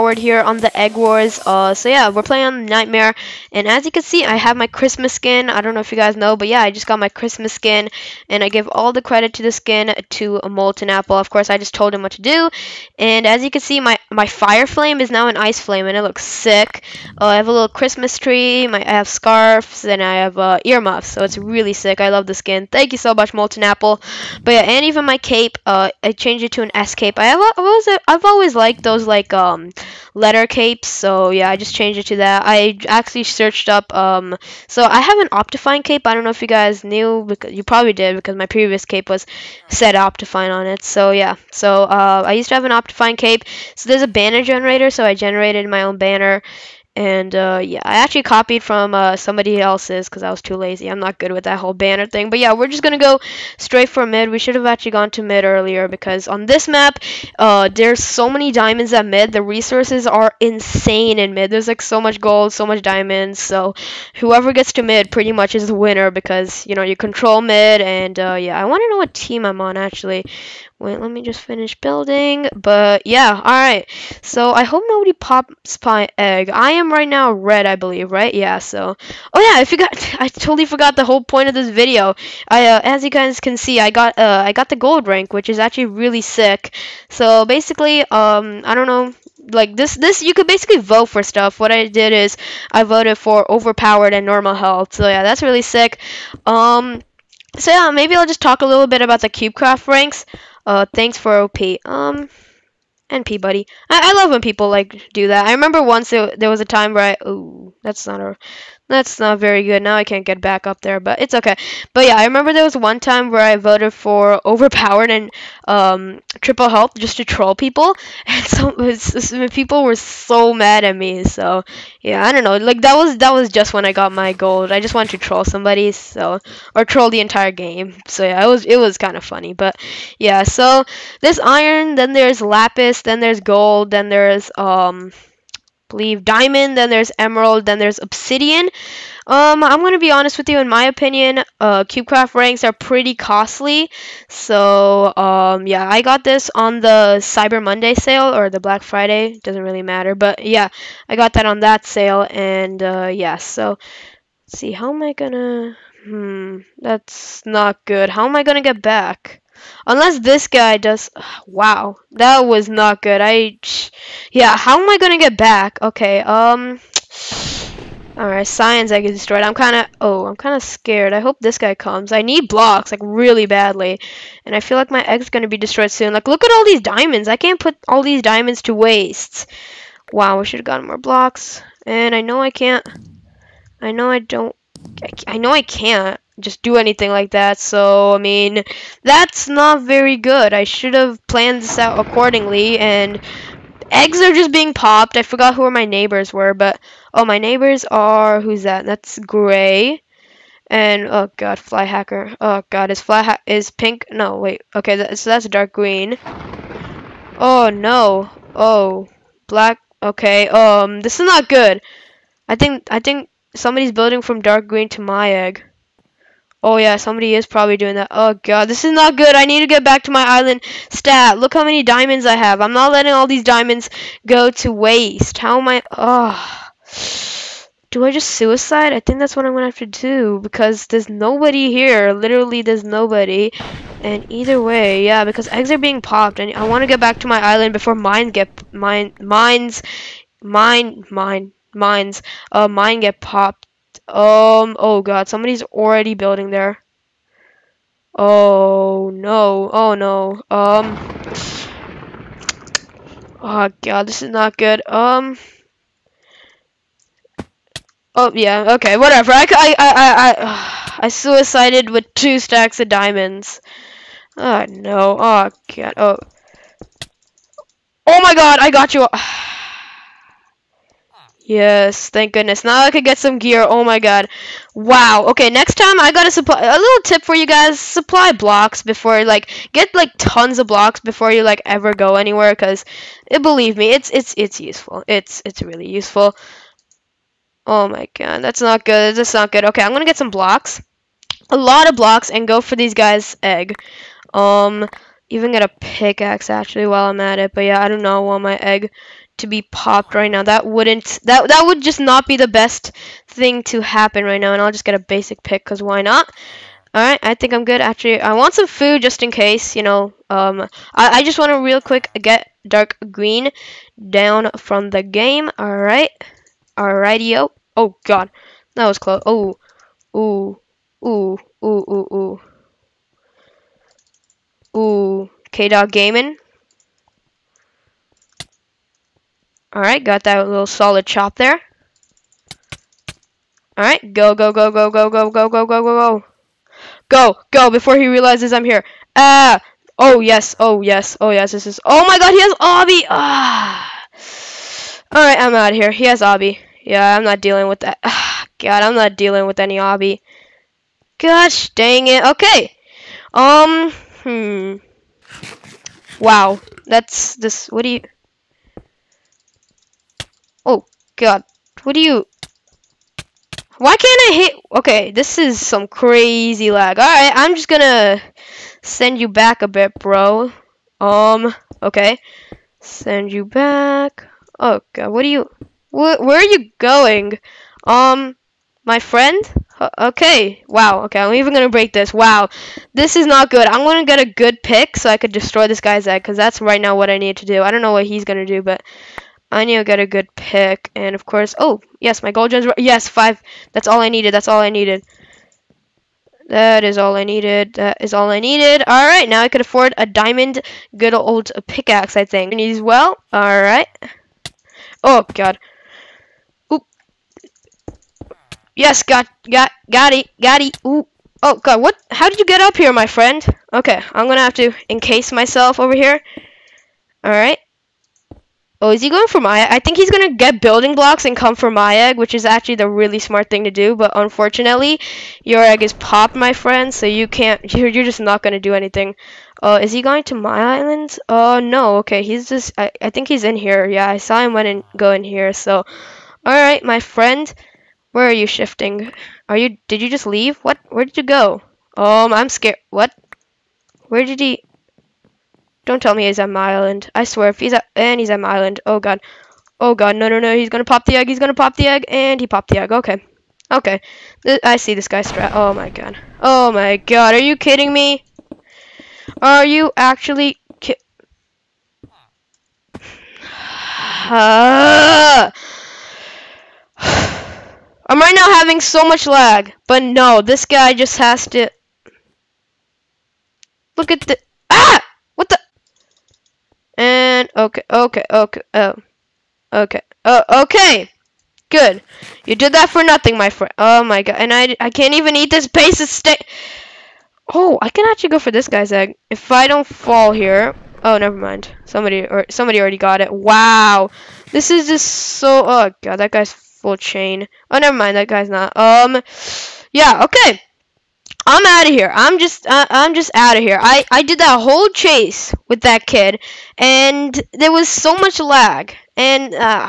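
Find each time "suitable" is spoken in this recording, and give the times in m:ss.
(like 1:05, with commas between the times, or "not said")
not said.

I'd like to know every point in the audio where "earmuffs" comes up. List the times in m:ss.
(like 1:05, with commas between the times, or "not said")
0:20.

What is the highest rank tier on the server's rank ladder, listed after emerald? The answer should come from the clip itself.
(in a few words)
obsidian.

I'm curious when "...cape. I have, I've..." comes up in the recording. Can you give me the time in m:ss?
0:26.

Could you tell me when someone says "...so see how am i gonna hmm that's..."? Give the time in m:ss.
2:33.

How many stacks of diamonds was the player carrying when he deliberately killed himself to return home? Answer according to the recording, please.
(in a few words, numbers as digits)
2.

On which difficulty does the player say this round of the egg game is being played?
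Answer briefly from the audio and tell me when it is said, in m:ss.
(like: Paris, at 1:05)
Nightmare, at 0:02.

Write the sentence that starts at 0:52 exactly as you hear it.
But yeah, we're just going to go straight for mid.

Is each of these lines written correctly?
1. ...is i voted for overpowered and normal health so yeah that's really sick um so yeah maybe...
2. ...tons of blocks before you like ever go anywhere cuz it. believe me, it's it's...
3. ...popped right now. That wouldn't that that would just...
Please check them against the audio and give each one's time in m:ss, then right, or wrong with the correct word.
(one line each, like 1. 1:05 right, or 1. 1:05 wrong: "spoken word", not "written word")
1. 1:32 right
2. 4:40 right
3. 4:59 right.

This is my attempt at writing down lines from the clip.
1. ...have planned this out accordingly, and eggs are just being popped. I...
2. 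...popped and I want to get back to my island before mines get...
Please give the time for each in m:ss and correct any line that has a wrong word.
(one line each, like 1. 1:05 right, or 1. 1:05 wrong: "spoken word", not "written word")
1. 3:10 right
2. 3:56 right.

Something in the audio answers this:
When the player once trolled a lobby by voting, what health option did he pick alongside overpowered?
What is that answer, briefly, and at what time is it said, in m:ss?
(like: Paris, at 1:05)
triple health, at 1:56.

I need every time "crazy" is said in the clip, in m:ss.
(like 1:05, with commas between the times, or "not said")
6:05.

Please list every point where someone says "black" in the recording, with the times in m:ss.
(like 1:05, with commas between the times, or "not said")
2:28, 3:29.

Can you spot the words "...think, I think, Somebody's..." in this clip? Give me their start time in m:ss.
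3:32.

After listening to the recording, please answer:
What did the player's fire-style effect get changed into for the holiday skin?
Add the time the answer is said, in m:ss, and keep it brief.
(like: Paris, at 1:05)
Ice Flame, at 0:15.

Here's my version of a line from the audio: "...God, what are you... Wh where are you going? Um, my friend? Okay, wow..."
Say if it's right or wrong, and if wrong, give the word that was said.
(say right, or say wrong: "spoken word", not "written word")
right.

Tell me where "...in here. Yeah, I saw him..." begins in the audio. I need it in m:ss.
7:13.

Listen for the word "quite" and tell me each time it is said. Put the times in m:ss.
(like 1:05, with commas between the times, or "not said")
not said.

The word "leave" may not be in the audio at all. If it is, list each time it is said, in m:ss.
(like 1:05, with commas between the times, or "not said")
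7:20.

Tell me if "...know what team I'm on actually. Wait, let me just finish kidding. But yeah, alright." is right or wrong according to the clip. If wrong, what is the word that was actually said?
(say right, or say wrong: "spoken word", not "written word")
wrong: "building", not "kidding".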